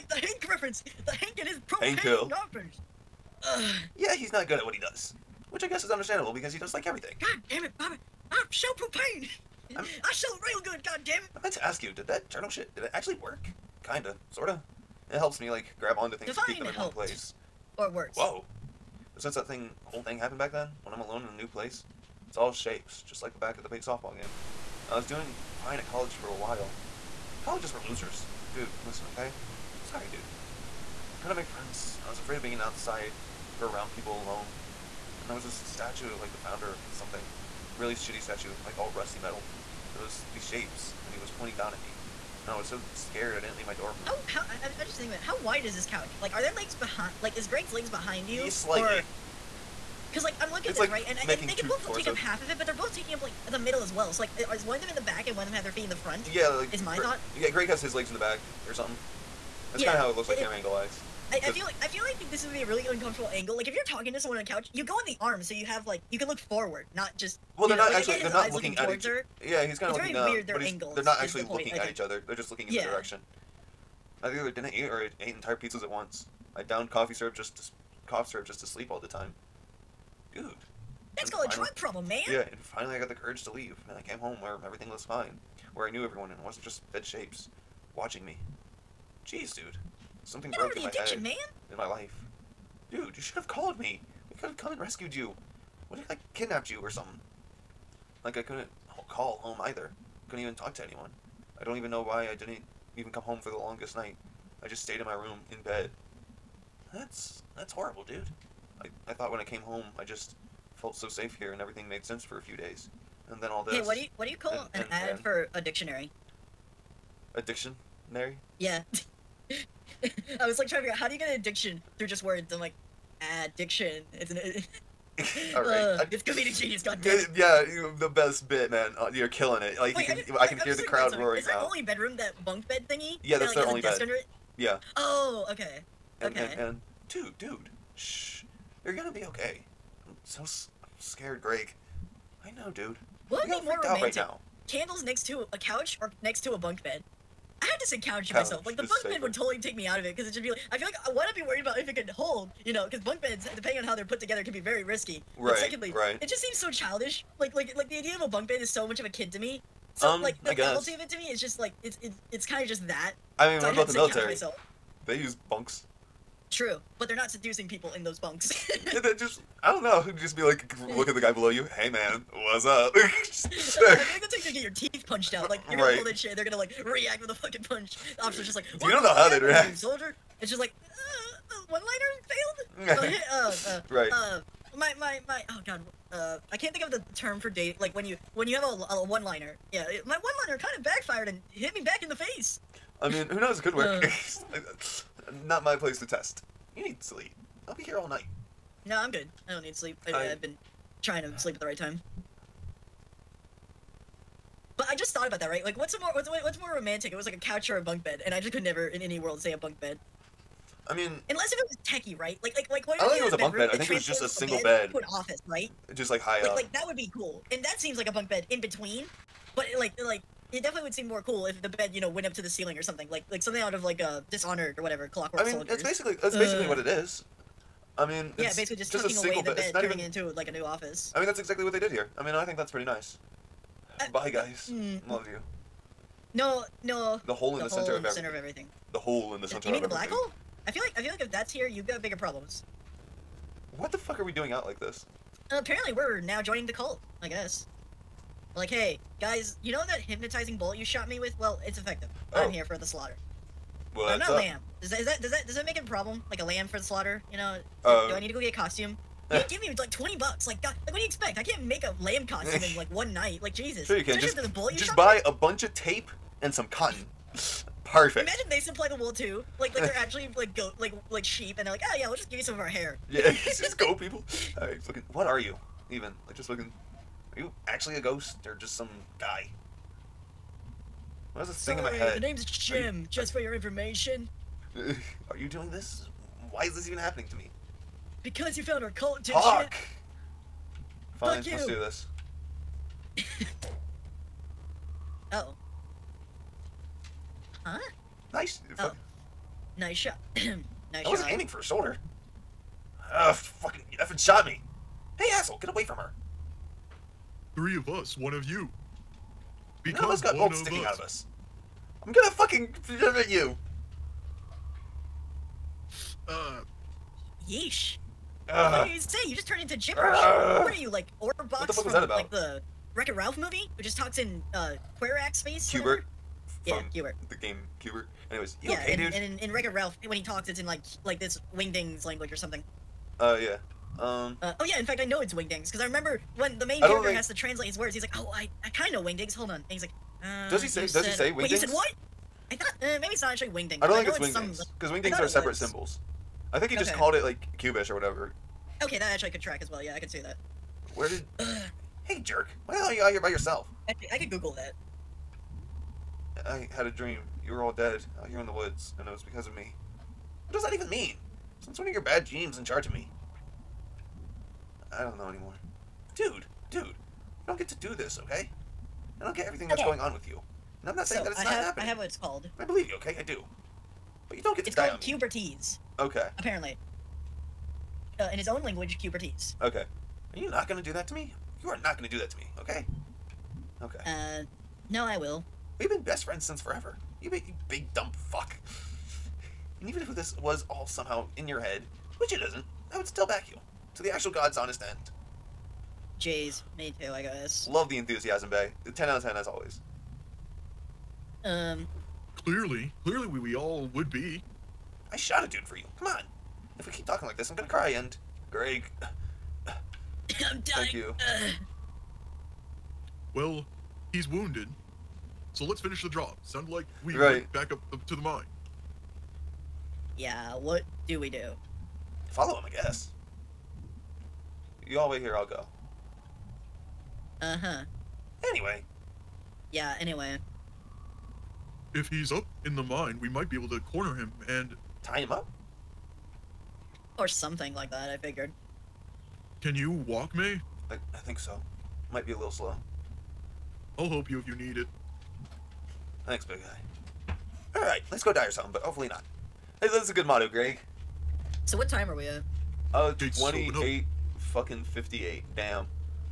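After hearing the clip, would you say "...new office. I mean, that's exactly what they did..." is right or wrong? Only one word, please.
right.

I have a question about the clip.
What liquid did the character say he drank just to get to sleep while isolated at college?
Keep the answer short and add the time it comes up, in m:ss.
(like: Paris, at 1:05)
cough syrup, at 1:18.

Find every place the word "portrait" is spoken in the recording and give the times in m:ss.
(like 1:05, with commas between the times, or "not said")
not said.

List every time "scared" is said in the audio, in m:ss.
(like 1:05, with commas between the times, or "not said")
0:42, 2:20.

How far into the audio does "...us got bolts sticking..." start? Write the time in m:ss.
5:10.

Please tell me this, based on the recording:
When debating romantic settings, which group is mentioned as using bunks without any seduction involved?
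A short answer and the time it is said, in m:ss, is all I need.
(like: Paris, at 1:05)
the military, at 2:43.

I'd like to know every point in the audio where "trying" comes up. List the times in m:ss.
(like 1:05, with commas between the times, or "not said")
2:00, 3:21.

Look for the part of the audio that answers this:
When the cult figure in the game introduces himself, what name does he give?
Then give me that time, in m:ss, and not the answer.
4:42.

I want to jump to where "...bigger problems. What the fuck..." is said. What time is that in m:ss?
4:02.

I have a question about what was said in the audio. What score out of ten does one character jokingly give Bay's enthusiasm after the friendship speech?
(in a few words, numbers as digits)
10 out of 10.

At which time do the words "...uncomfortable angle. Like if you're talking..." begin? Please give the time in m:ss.
1:02.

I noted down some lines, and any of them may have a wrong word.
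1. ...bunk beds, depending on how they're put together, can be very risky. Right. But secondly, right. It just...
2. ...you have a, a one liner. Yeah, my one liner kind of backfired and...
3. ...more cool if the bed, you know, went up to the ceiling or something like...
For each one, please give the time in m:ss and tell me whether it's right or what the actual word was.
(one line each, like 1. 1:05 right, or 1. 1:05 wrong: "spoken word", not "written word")
1. 2:32 right
2. 3:08 right
3. 3:41 right.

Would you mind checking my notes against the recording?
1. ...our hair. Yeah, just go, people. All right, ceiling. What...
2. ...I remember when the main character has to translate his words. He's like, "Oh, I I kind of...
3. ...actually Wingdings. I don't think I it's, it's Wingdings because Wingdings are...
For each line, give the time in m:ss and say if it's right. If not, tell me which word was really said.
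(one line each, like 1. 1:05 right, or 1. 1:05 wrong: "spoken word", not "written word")
1. 4:32 wrong: "fucking", not "ceiling"
2. 5:35 right
3. 5:43 right.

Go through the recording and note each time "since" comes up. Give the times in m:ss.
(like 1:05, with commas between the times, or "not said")
0:19, 6:01, 6:26.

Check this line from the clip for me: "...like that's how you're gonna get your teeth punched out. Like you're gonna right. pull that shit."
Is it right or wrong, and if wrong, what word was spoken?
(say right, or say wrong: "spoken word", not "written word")
right.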